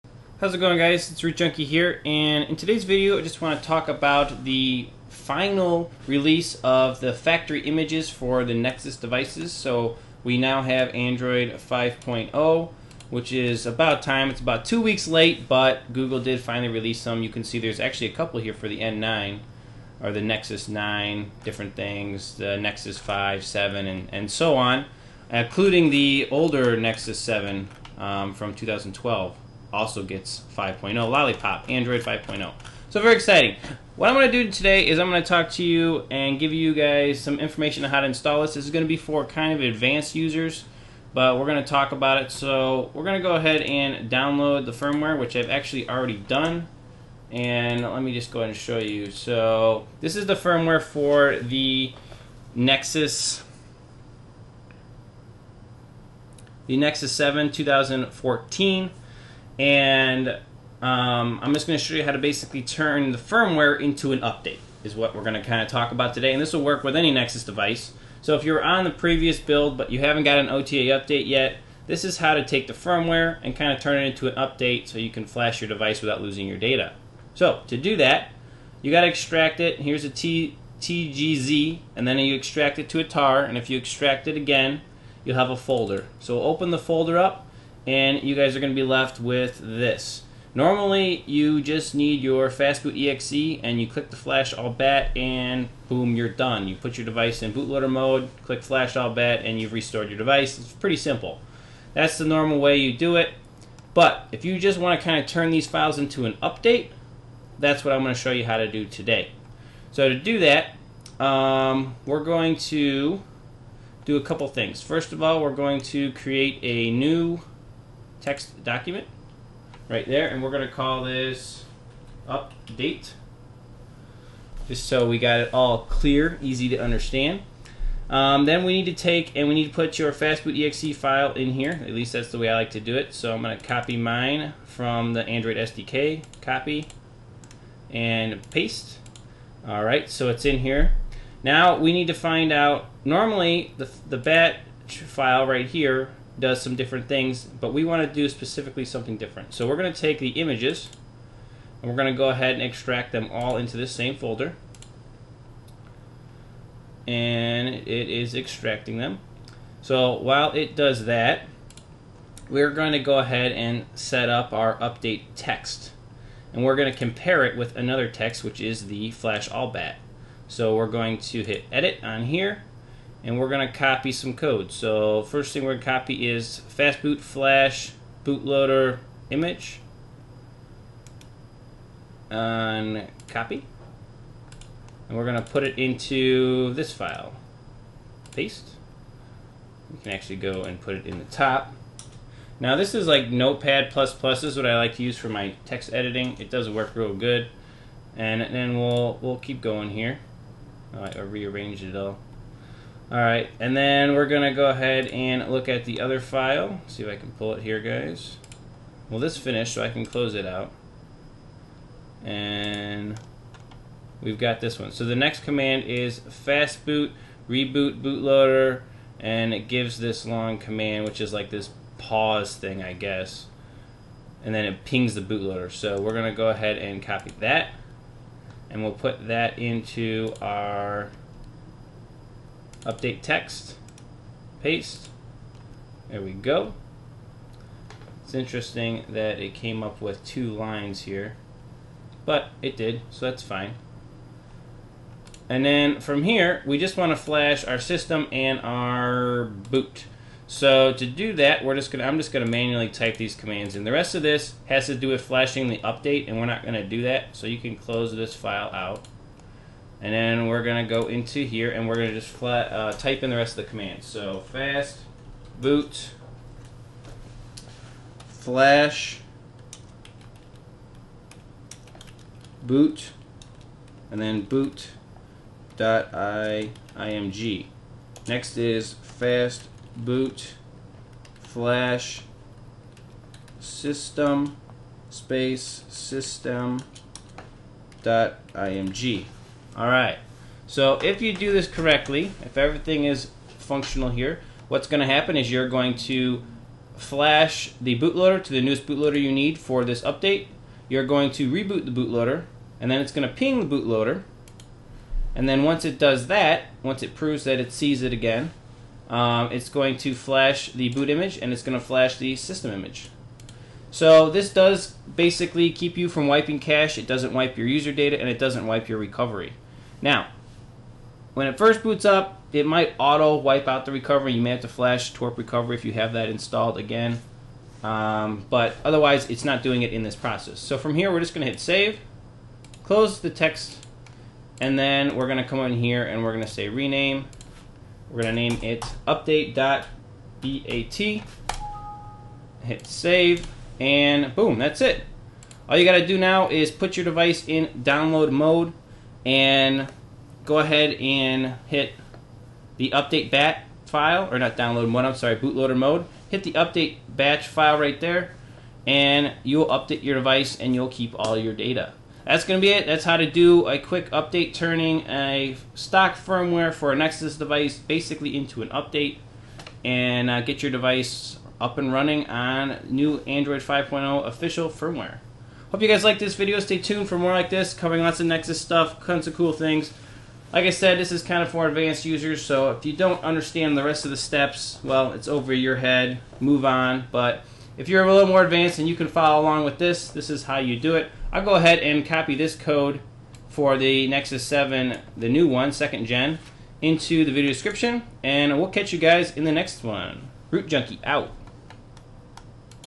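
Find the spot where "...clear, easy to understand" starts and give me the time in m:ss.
2:05.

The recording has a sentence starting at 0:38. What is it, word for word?
This is going to be for kind of advanced users, but we're going to talk about it.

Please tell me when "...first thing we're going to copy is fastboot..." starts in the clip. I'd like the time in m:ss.
2:55.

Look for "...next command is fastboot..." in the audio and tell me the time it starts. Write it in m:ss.
3:35.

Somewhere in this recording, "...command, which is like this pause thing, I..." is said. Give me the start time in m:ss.
3:40.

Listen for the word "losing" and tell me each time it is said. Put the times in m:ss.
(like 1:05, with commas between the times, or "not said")
1:16.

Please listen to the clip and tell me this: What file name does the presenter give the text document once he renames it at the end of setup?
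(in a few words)
update.bat.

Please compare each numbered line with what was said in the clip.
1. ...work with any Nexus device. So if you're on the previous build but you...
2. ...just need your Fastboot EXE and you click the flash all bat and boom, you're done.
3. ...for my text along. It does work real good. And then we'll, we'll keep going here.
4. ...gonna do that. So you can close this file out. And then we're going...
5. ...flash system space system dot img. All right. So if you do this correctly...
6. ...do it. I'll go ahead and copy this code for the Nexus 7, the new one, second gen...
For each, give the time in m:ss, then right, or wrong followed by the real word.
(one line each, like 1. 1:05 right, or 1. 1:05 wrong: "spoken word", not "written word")
1. 1:06 right
2. 1:31 right
3. 3:15 wrong: "editing", not "along"
4. 4:16 right
5. 4:41 right
6. 6:30 right.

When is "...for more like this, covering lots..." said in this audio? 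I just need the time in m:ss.
6:17.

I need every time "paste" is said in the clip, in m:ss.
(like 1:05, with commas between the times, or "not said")
2:18, 3:08, 3:54.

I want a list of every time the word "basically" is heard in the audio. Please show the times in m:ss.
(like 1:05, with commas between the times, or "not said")
1:02, 5:15, 6:07.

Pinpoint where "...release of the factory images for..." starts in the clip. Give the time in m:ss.
0:06.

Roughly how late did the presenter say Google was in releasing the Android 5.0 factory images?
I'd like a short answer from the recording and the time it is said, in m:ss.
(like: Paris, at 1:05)
two weeks, at 0:14.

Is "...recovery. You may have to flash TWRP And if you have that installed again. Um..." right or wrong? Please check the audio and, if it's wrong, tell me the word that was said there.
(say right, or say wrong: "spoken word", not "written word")
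wrong: "Recovery", not "And".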